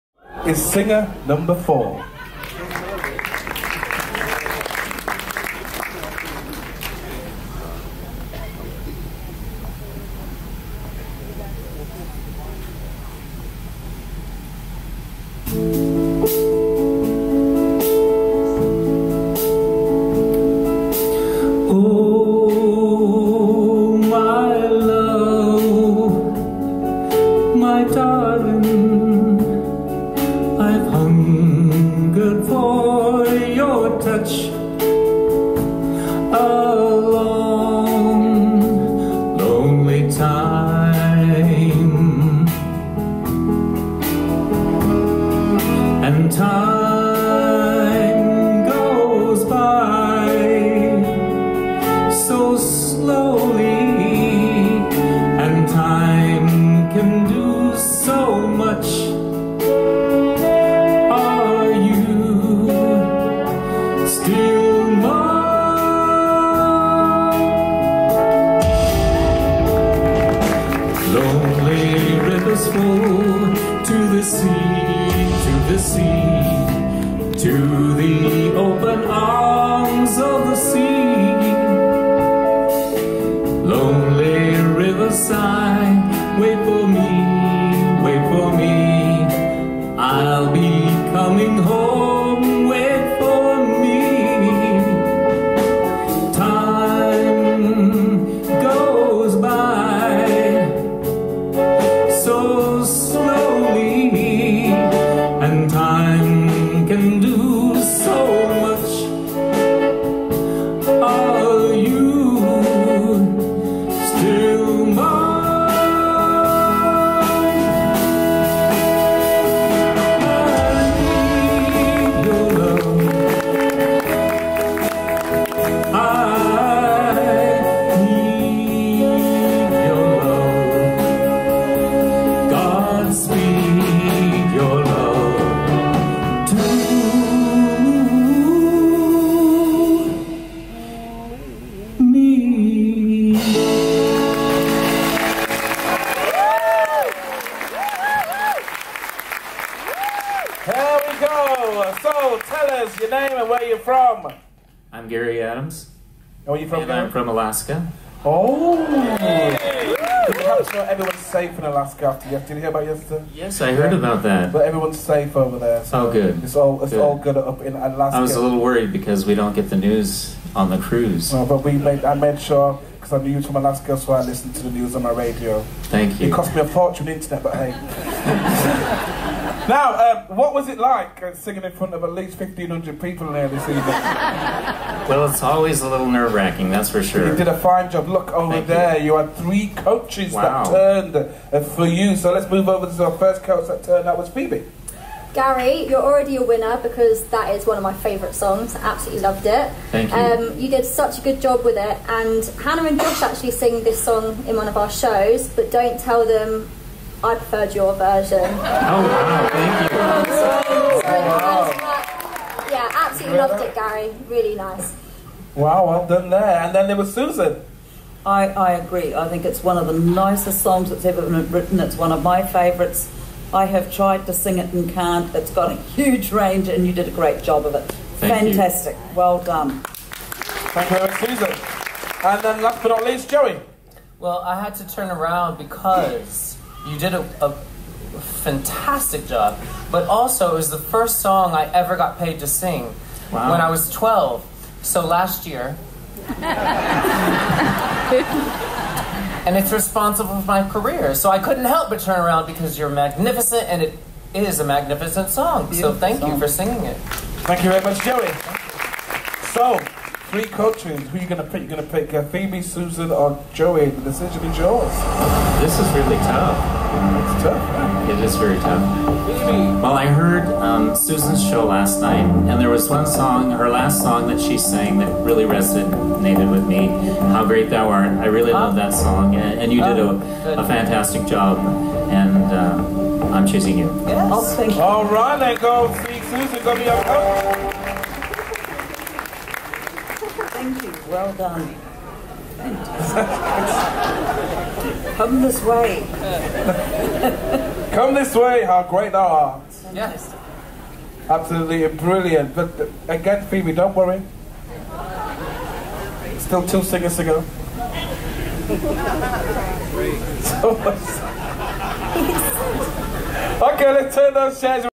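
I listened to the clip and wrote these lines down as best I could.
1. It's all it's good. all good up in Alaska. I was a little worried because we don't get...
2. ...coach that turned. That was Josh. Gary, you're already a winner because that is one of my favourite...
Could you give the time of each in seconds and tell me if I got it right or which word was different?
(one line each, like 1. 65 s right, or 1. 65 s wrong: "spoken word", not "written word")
1. 166 s right
2. 193 s wrong: "Phoebe", not "Josh".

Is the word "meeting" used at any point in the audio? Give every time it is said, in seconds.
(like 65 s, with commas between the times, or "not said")
not said.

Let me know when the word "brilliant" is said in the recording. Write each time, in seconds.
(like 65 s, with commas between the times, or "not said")
301 s.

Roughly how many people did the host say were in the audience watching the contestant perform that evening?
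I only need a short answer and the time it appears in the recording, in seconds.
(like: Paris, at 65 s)
1,500, at 182 s.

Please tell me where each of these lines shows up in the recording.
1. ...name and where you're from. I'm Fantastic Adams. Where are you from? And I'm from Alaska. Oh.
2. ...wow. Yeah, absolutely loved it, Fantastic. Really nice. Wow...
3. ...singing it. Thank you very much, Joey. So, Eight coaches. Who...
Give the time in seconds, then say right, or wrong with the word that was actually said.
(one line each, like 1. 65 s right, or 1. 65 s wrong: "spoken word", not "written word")
1. 153 s wrong: "Gary", not "Fantastic"
2. 211 s wrong: "Gary", not "Fantastic"
3. 256 s wrong: "Three", not "Eight".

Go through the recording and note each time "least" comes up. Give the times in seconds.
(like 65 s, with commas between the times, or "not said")
182 s, 233 s.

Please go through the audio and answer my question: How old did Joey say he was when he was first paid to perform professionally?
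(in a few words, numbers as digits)
12.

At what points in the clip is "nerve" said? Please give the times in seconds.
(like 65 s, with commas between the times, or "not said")
186 s.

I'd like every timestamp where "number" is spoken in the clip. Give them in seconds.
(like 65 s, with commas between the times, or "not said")
1 s.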